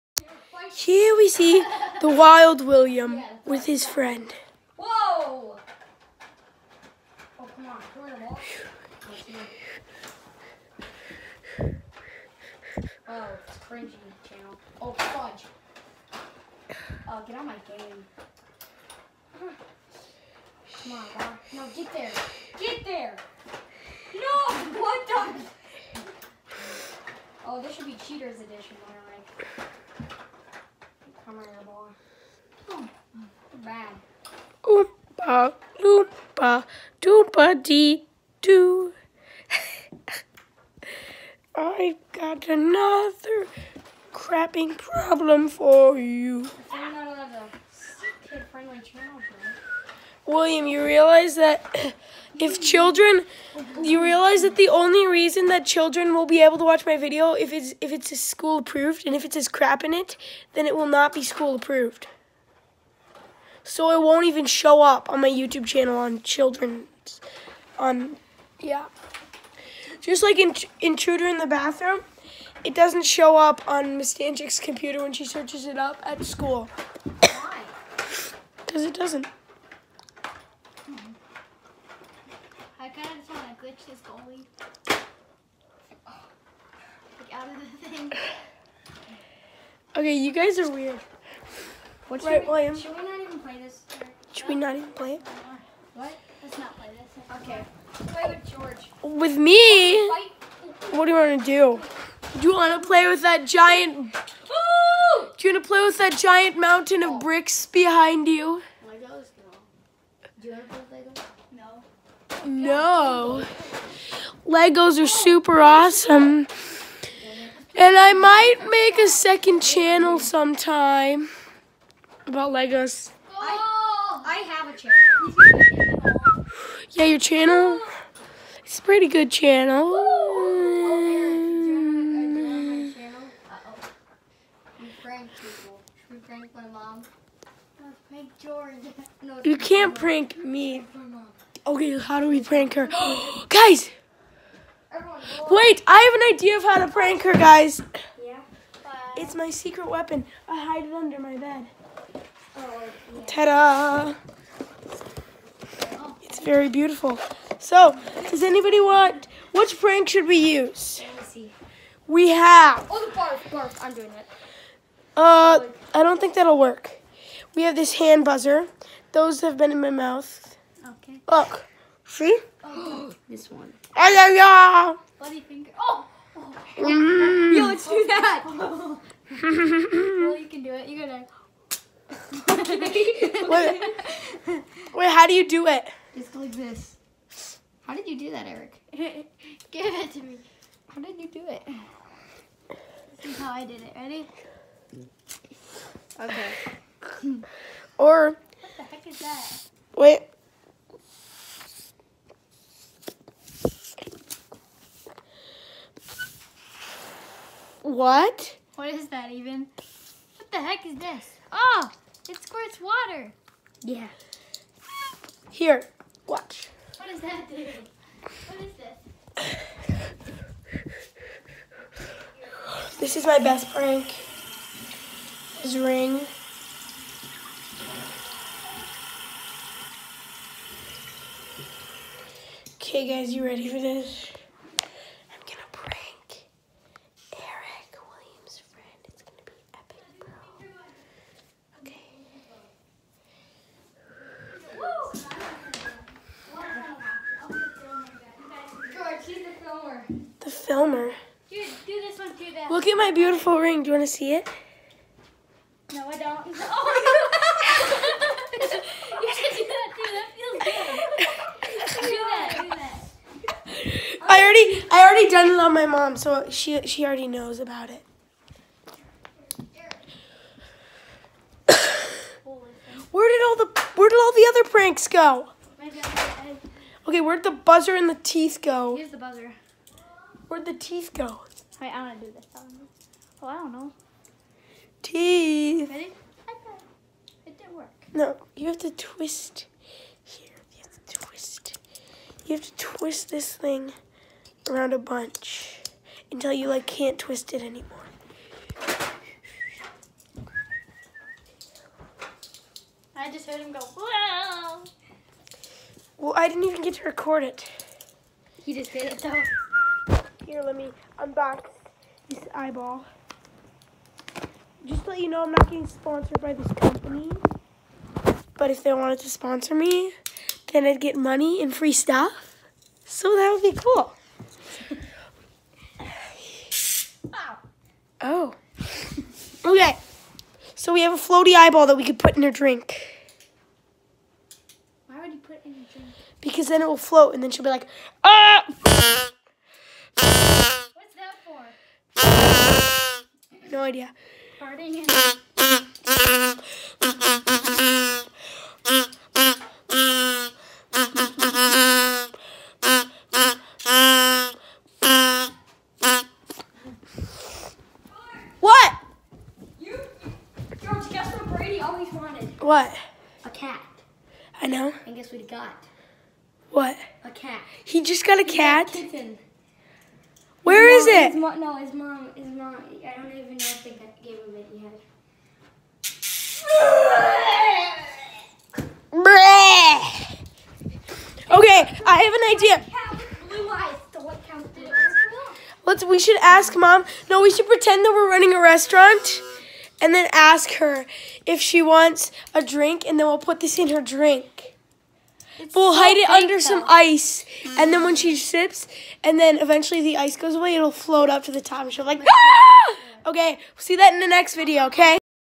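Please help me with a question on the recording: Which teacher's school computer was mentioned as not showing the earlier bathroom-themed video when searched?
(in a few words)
Miss Danchik.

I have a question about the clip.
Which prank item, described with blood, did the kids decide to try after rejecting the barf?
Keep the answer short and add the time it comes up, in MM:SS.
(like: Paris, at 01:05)
Bloody finger, at 02:55.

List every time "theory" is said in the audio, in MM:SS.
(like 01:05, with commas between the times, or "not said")
not said.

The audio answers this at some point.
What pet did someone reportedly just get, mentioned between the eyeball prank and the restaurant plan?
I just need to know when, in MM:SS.
06:09.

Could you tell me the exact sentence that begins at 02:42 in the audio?
Oh, the barf, barf, I'm doing it.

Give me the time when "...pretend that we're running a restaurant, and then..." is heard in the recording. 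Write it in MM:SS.
06:27.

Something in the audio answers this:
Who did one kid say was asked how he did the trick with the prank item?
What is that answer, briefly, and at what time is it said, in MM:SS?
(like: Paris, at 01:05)
Eric, at 03:08.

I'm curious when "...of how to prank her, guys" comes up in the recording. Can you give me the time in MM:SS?
02:26.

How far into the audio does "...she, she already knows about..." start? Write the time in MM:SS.
04:26.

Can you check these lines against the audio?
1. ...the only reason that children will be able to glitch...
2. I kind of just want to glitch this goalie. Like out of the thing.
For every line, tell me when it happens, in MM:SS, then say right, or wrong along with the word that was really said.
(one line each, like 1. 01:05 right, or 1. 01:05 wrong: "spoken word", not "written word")
1. 00:54 wrong: "watch", not "glitch"
2. 01:22 right.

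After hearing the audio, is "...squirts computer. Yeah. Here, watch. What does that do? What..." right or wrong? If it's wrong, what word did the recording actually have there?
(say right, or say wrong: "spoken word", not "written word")
wrong: "water", not "computer".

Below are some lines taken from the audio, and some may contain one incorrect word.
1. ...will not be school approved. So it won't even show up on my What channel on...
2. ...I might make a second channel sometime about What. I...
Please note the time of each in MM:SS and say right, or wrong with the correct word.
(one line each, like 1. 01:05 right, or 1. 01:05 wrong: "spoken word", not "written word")
1. 01:00 wrong: "YouTube", not "What"
2. 01:57 wrong: "Legos", not "What".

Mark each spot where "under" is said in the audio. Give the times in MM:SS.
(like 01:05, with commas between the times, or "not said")
02:30, 06:36.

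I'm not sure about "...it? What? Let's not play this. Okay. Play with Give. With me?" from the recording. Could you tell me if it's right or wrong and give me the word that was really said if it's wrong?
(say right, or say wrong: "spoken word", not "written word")
wrong: "George", not "Give".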